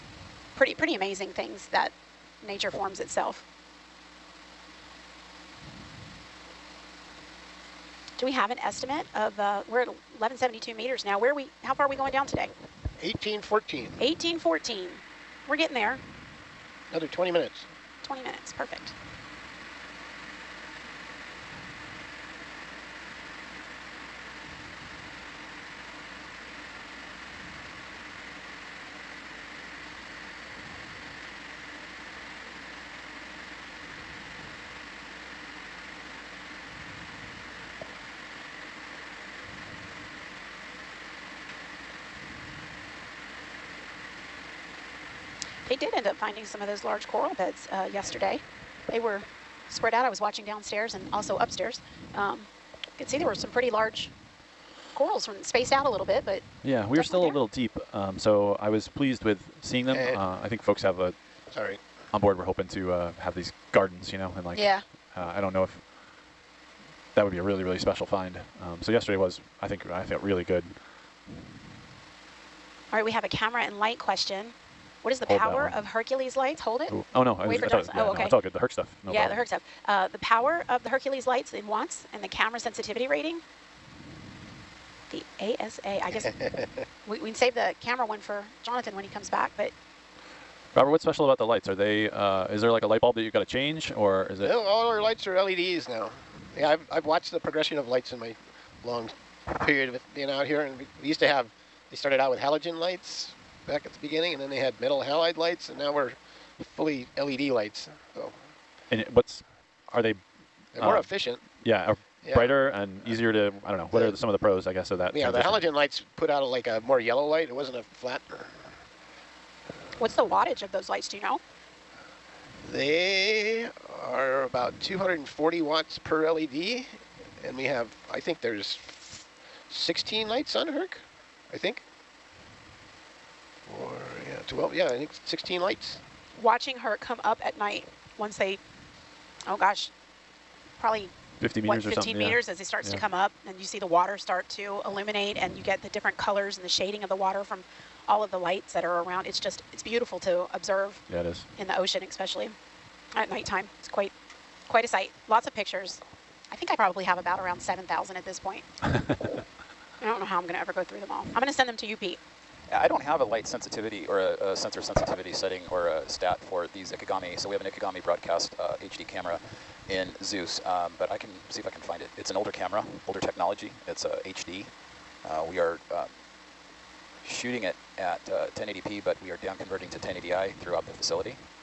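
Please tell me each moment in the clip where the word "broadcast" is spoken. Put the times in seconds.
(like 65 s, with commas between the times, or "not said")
168 s.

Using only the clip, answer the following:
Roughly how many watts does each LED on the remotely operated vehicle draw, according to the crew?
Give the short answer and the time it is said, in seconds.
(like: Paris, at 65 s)
240 watts, at 124 s.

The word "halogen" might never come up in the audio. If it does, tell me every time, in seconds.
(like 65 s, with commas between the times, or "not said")
102 s, 115 s.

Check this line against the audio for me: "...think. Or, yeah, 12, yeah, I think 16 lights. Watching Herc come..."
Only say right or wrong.
right.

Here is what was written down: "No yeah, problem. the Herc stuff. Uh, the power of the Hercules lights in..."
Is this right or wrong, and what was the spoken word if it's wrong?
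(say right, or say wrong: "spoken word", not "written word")
right.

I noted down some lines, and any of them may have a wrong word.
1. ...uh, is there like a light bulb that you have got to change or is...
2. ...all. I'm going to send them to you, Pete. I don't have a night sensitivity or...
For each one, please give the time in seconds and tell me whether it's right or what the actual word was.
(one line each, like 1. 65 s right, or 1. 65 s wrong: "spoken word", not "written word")
1. 92 s right
2. 161 s wrong: "light", not "night".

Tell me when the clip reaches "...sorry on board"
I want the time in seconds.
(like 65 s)
61 s.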